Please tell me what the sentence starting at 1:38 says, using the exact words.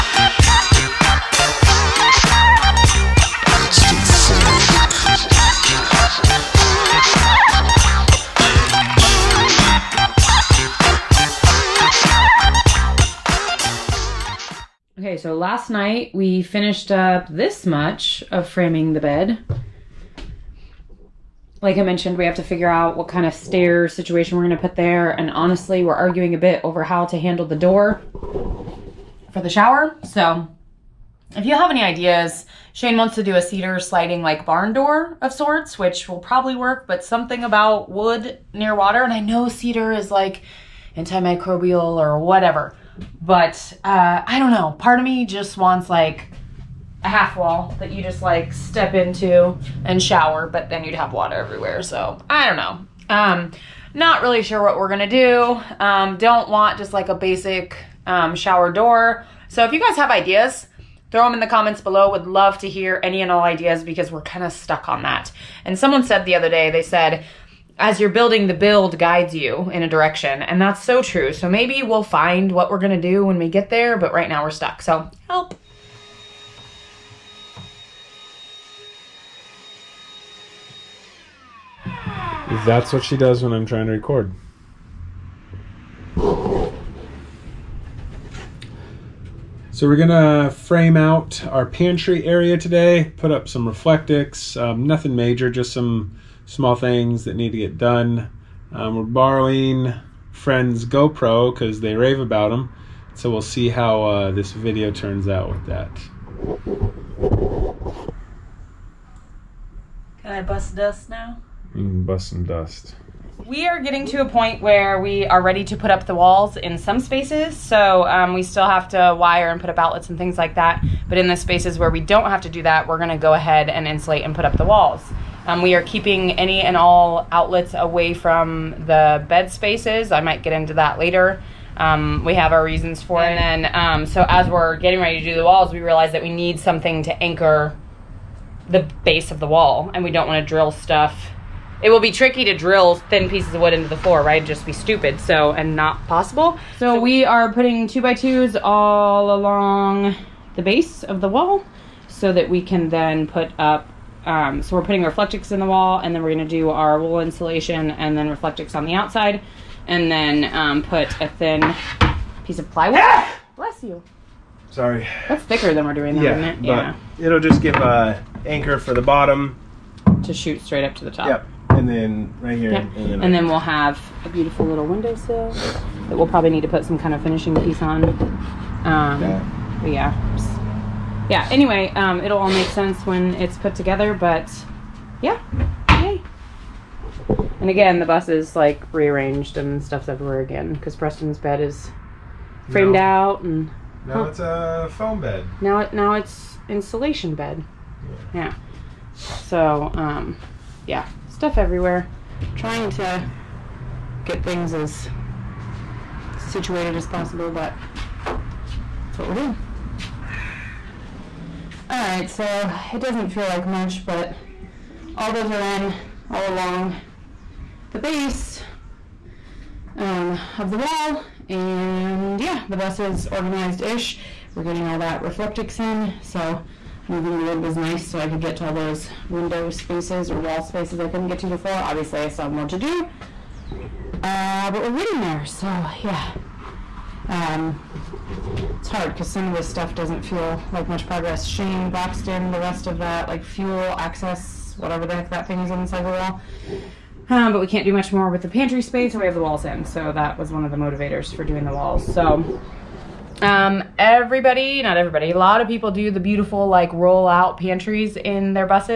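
Um, we're borrowing friends GoPro because they rave about them.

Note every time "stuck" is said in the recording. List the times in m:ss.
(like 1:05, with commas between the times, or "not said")
1:04, 1:14.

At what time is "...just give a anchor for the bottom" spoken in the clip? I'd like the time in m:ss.
2:47.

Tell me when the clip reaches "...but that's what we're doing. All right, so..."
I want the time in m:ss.
3:27.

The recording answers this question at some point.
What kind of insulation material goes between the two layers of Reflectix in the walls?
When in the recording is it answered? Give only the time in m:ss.
2:36.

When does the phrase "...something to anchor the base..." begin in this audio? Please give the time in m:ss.
2:16.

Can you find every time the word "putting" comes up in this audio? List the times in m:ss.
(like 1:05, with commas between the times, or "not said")
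2:27, 2:34.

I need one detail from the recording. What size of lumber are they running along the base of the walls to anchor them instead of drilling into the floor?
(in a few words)
two by twos.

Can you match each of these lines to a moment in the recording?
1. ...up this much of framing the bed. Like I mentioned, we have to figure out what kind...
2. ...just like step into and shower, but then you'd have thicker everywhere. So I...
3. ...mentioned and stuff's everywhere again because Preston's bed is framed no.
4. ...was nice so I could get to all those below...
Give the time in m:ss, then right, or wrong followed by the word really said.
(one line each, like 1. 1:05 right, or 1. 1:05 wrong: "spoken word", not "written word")
1. 0:16 right
2. 0:48 wrong: "water", not "thicker"
3. 3:08 wrong: "rearranged", not "mentioned"
4. 3:47 wrong: "window", not "below".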